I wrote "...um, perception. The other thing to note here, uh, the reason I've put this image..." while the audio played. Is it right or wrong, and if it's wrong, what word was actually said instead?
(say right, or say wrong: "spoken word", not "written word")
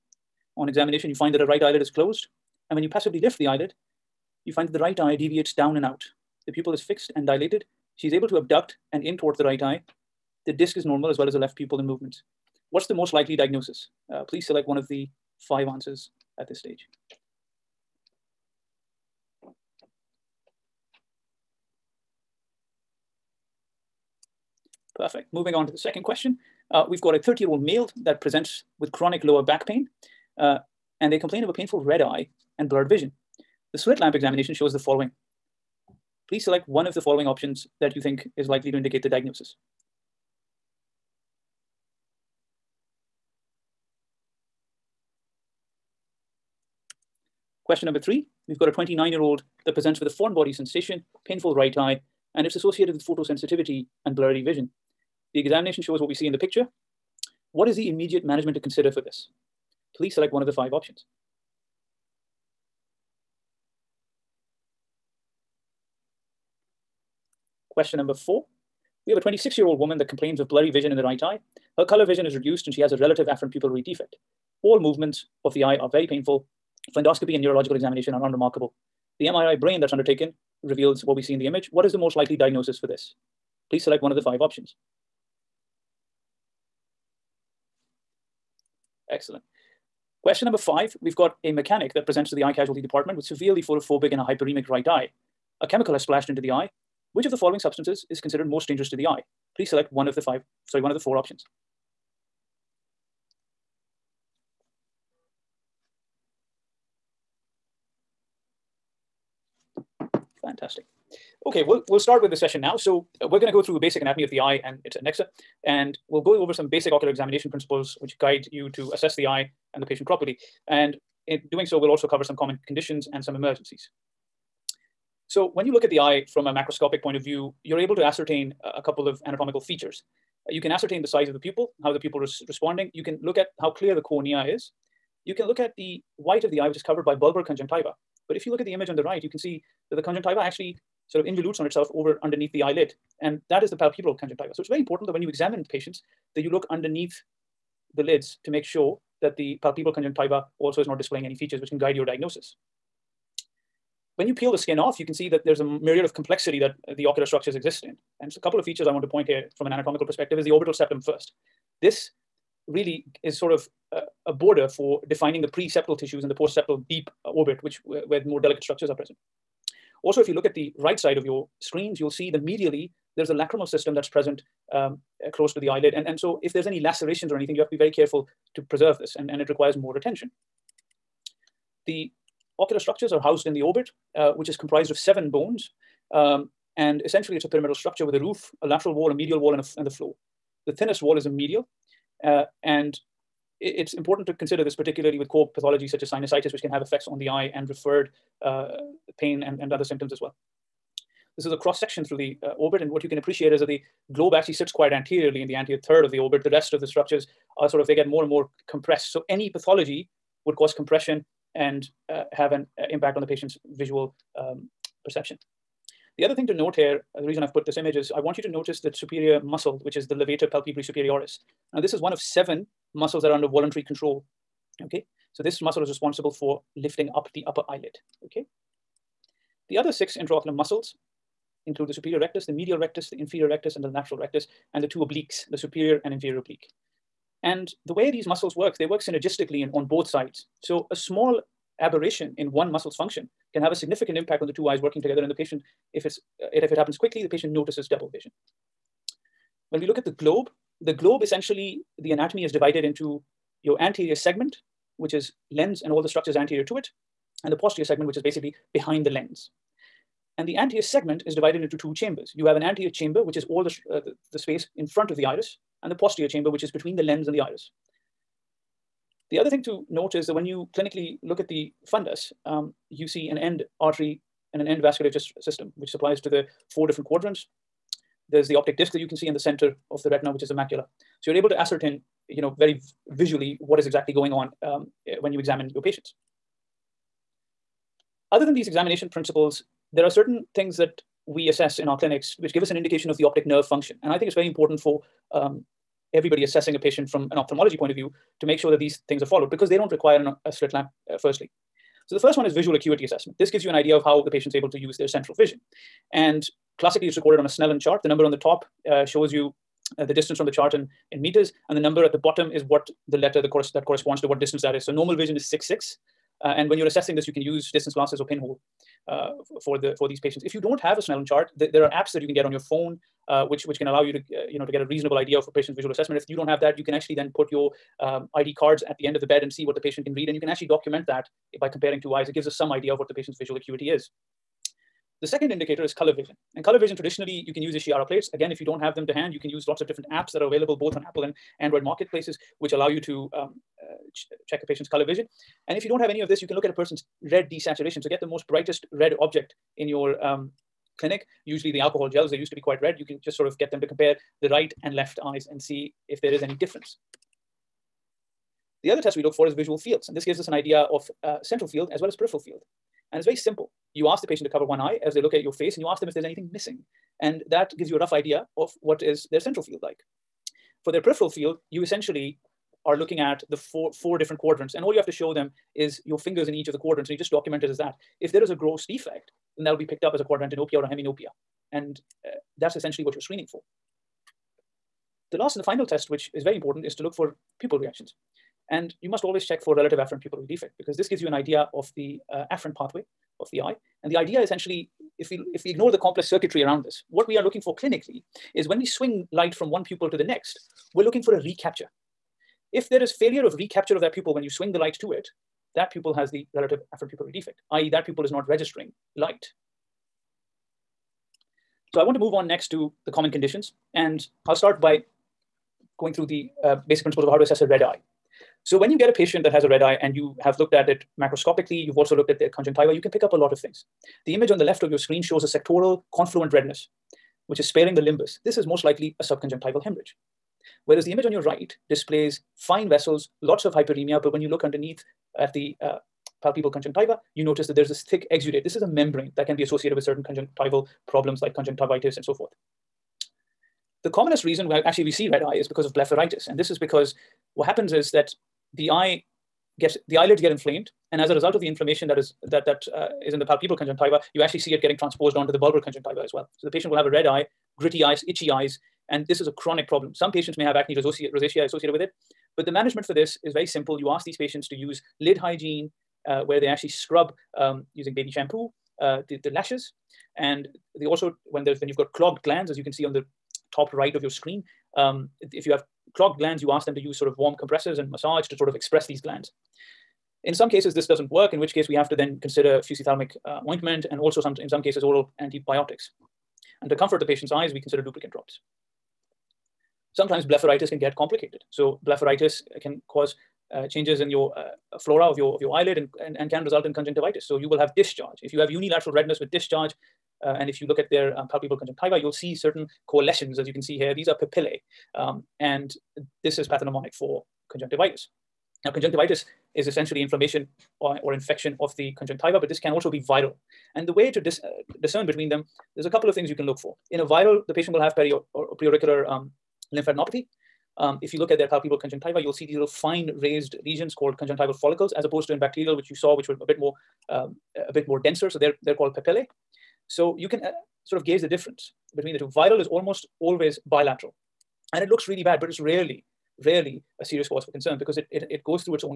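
right.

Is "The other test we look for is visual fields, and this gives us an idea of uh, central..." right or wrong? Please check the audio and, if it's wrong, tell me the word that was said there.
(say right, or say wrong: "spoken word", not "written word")
right.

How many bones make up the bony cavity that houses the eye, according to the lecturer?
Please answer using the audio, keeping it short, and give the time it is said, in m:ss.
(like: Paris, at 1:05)
7, at 3:04.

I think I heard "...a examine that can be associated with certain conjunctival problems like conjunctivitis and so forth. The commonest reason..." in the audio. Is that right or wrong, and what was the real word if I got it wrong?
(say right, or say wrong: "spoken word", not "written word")
wrong: "membrane", not "examine".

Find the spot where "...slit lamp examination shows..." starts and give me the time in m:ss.
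0:33.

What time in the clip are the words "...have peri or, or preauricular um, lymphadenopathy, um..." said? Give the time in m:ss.
8:37.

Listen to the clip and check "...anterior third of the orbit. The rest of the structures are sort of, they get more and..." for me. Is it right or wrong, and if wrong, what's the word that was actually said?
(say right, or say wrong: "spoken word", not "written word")
right.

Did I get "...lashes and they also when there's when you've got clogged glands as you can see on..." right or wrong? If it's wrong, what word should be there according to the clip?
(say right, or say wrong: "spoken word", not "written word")
right.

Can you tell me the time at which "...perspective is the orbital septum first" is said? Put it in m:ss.
2:40.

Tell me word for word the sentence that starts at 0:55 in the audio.
The examination shows what we see in the picture.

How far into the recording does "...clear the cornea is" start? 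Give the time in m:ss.
2:13.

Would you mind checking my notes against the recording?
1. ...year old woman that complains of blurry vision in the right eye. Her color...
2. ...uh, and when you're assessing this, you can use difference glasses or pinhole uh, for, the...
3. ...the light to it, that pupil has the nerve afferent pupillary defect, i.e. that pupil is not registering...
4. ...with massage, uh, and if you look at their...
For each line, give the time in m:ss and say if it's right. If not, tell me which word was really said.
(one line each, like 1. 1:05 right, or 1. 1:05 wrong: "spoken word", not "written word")
1. 1:09 right
2. 5:16 wrong: "distance", not "difference"
3. 6:44 wrong: "relative", not "nerve"
4. 8:19 wrong: "discharge", not "massage".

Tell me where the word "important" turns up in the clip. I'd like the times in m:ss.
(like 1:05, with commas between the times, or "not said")
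2:24, 3:13, 4:54, 6:26.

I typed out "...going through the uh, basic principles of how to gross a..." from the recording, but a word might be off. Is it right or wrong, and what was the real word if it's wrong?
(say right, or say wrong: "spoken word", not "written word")
wrong: "assess", not "gross".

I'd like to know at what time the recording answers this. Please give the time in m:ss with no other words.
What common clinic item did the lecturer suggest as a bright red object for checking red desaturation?
5:51.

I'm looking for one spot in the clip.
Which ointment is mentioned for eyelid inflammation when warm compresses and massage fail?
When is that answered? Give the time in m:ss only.
8:02.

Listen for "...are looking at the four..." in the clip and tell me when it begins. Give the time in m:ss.
6:12.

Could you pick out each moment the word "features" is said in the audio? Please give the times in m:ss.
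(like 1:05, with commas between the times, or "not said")
2:09, 2:31, 2:38.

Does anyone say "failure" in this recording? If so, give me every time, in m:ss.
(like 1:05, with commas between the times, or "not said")
6:43.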